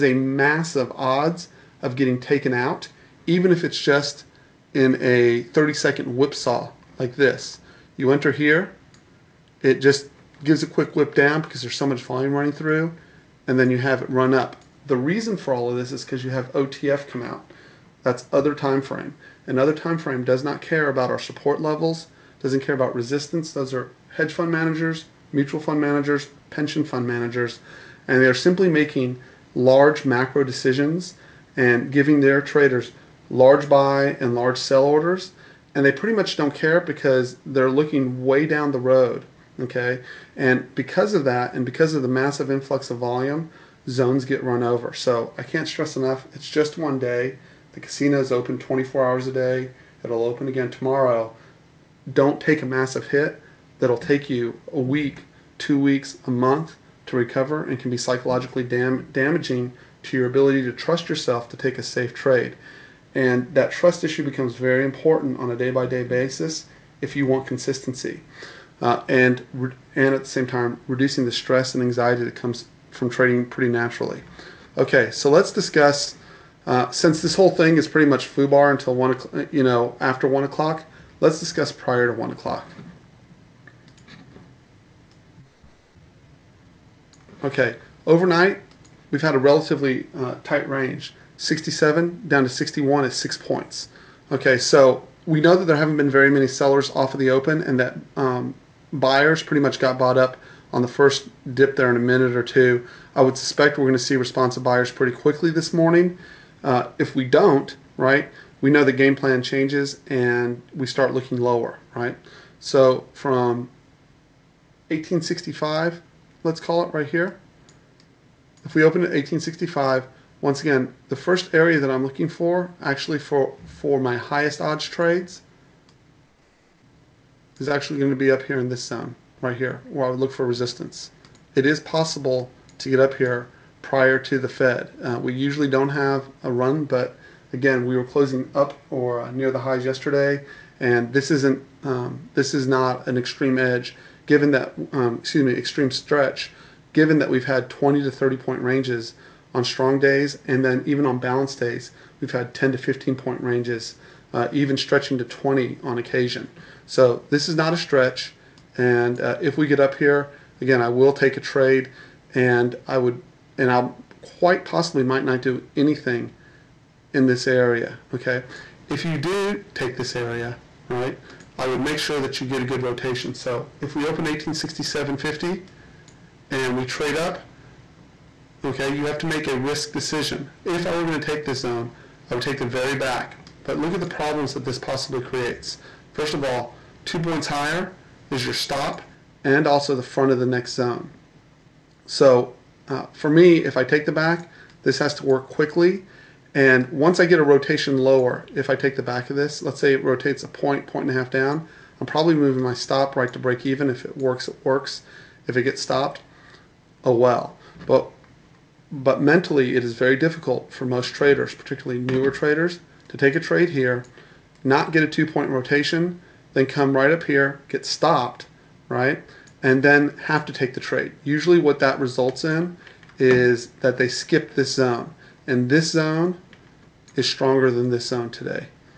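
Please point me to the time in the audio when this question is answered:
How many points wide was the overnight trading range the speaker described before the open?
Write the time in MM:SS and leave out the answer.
01:33.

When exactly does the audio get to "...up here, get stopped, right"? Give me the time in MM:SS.
03:37.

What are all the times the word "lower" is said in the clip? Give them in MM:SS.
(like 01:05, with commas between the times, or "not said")
01:51, 03:17.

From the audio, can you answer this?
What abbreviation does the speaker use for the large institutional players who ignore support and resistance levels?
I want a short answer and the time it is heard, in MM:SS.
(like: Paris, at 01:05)
OTF, at 00:16.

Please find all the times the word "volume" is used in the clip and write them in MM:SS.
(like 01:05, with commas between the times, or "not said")
00:12, 00:42.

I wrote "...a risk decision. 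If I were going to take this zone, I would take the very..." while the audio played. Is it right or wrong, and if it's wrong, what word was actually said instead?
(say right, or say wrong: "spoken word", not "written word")
right.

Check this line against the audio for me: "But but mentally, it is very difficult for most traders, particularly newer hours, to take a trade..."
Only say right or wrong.
wrong.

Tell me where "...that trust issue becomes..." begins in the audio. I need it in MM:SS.
01:03.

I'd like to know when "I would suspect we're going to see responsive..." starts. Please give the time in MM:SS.
01:43.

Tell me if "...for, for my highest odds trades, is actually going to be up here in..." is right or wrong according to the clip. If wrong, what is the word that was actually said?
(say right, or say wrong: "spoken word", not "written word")
right.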